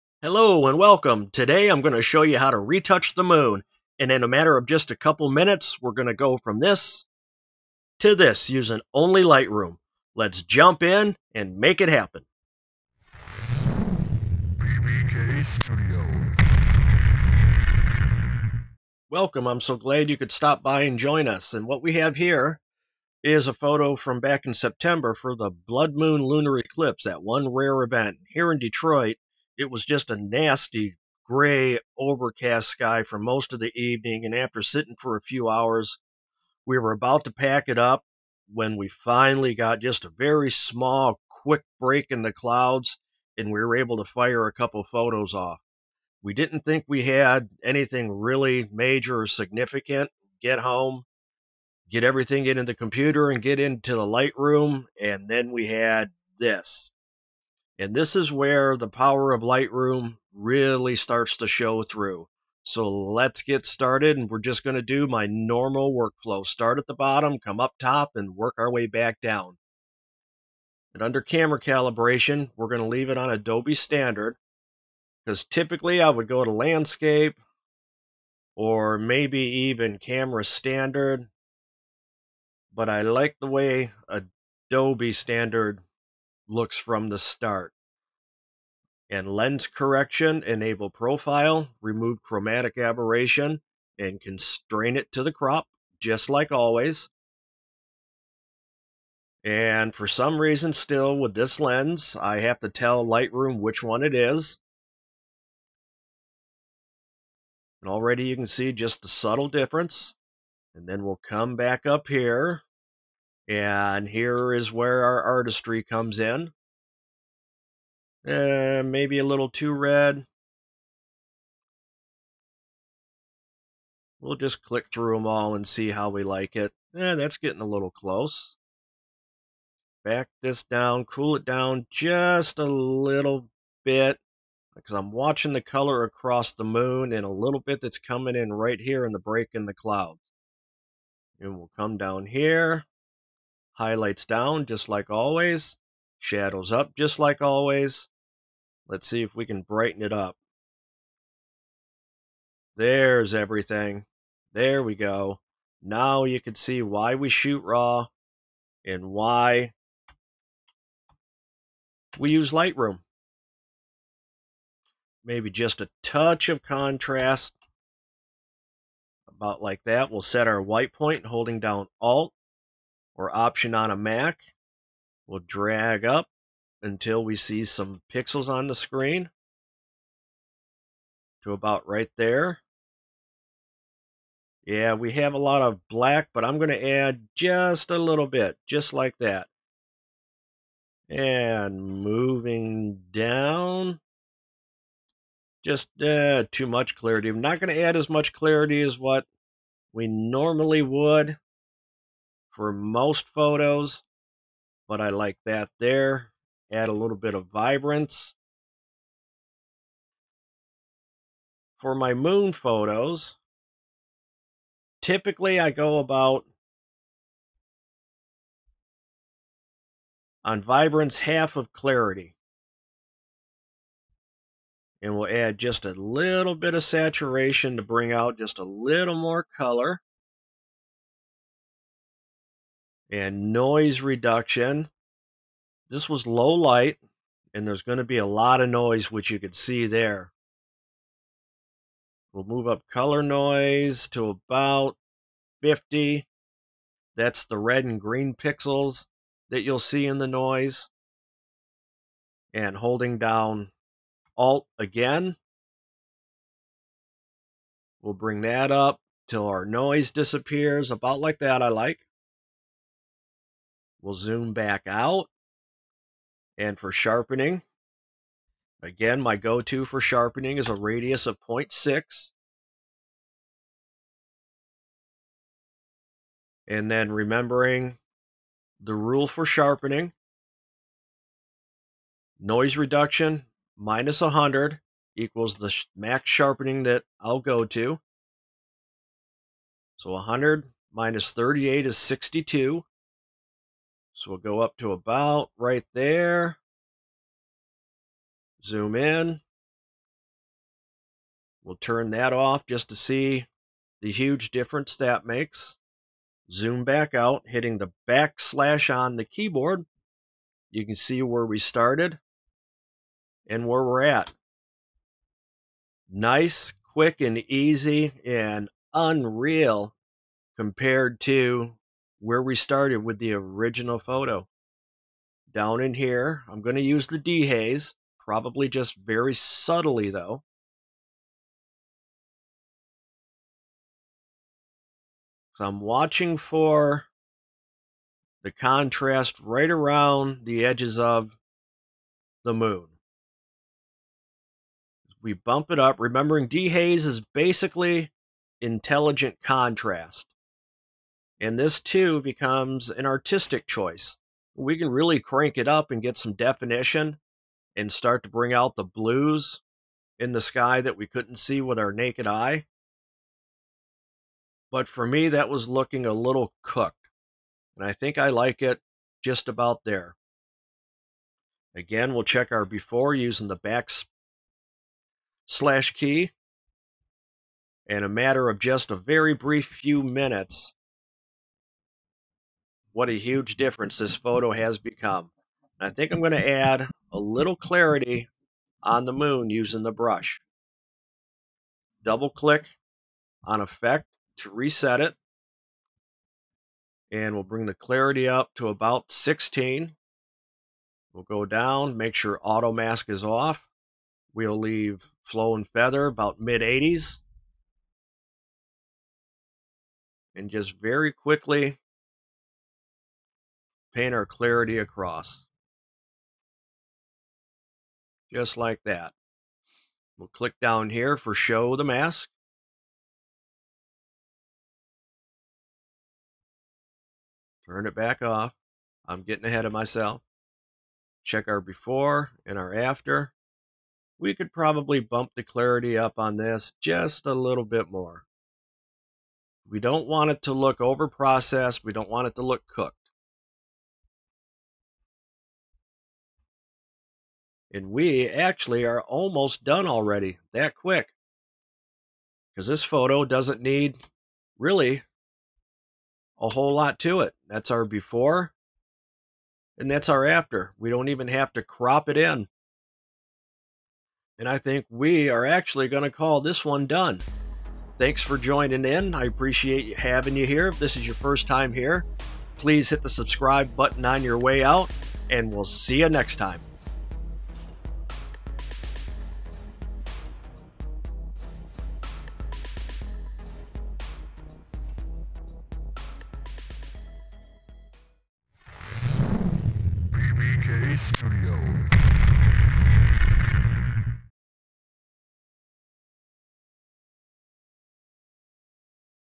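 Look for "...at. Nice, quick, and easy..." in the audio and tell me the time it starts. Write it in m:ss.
5:14.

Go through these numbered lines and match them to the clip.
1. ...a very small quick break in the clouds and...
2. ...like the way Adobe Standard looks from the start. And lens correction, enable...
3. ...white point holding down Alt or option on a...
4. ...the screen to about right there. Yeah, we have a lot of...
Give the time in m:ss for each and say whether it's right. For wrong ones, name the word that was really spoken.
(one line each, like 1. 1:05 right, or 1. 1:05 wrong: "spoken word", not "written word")
1. 0:40 right
2. 1:23 right
3. 2:50 right
4. 2:58 right.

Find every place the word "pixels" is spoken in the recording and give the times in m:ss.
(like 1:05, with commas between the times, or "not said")
2:58, 4:08.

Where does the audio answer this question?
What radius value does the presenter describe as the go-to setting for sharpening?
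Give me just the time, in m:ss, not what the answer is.
4:31.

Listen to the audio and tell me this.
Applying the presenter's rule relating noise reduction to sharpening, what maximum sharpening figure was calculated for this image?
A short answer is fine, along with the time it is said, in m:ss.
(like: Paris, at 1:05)
62, at 4:51.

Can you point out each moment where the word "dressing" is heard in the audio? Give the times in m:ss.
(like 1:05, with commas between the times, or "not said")
not said.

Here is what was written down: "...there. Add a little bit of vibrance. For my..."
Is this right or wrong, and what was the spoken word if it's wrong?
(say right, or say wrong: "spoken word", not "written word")
right.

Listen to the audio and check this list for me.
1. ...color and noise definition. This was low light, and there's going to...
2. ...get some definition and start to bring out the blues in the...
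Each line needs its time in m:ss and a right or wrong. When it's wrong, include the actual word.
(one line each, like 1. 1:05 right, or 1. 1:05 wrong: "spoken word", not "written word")
1. 3:49 wrong: "reduction", not "definition"
2. 5:55 right.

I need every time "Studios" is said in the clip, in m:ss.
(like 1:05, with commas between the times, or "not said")
0:15, 8:10.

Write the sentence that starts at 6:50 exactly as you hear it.
And just very quickly paint our clarity across.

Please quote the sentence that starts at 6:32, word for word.
Double click on effect to reset it.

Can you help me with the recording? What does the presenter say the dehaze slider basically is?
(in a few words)
Intelligent contrast.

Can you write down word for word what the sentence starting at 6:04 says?
But for me, that was looking a little cooked.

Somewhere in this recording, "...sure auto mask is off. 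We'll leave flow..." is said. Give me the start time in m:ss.
6:42.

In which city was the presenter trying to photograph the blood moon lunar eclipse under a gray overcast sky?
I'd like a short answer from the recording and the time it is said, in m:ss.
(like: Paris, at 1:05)
Detroit, at 0:28.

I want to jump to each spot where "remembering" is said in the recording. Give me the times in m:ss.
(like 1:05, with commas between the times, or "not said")
4:37, 5:45.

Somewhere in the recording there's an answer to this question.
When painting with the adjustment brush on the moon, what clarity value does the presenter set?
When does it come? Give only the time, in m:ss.
6:39.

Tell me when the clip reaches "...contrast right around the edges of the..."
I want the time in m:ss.
5:38.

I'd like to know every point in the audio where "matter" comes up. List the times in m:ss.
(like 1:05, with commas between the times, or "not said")
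0:04, 6:18.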